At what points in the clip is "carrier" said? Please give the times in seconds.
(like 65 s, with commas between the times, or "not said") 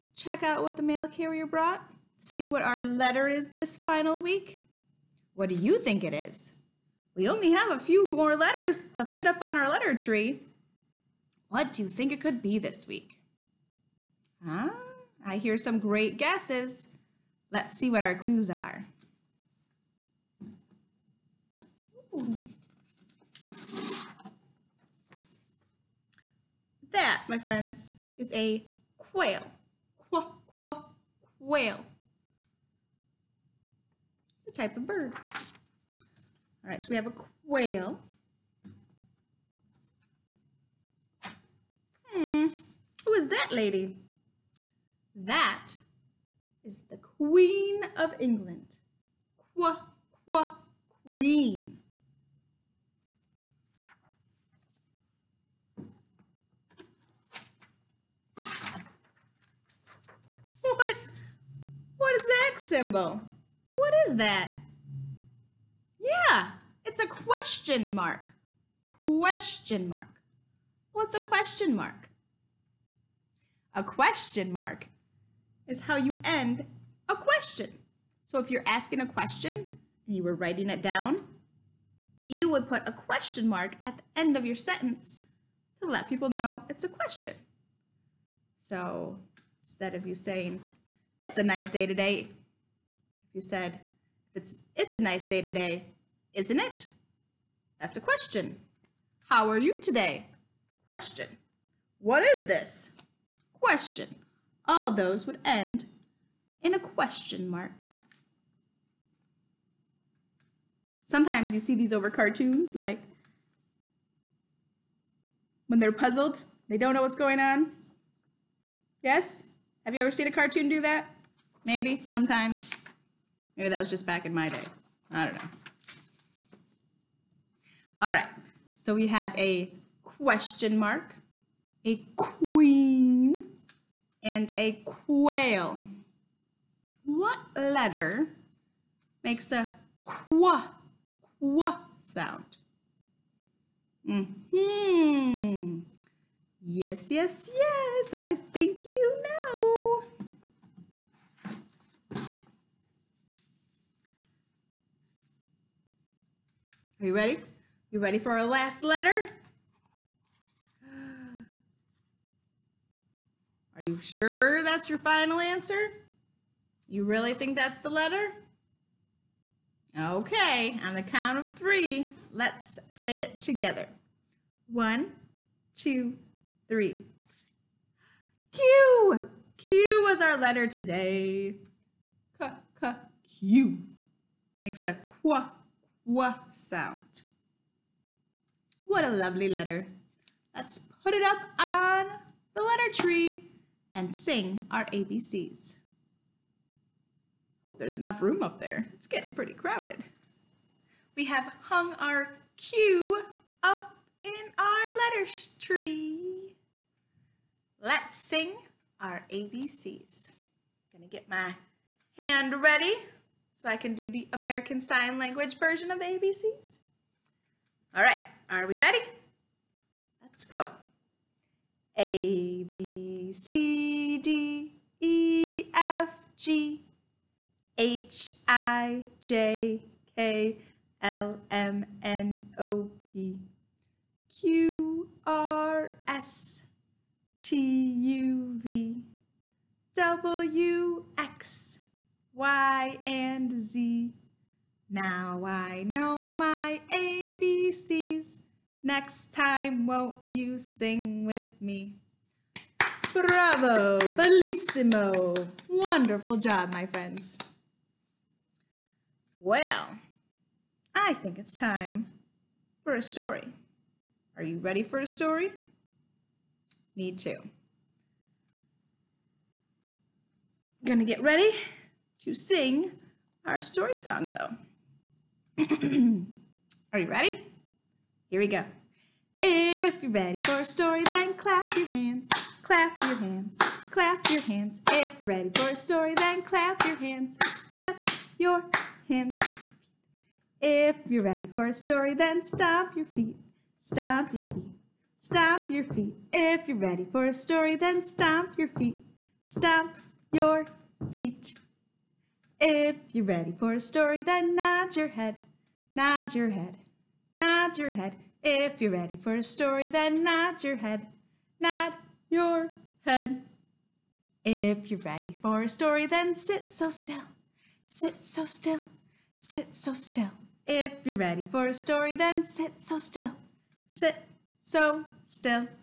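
1 s.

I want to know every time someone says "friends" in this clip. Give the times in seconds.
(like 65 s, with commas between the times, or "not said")
27 s, 256 s.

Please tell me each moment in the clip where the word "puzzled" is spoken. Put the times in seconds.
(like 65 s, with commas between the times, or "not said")
115 s.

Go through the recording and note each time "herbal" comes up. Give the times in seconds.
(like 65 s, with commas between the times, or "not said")
not said.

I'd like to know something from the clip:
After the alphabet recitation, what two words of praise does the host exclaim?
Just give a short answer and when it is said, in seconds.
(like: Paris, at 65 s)
Bravo, bellissimo, at 253 s.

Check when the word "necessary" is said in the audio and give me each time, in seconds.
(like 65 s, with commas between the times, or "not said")
not said.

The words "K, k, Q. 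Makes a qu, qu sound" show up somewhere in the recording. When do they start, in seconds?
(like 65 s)
182 s.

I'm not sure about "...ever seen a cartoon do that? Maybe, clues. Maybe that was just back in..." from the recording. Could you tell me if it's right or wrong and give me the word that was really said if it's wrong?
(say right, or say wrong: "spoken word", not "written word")
wrong: "sometimes", not "clues".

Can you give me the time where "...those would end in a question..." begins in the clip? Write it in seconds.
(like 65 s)
104 s.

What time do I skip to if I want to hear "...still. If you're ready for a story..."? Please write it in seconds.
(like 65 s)
319 s.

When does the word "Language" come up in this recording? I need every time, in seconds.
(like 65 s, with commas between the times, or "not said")
215 s.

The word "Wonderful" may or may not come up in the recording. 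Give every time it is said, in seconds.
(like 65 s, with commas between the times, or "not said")
255 s.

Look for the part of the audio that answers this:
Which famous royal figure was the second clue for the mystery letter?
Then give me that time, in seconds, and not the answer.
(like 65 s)
46 s.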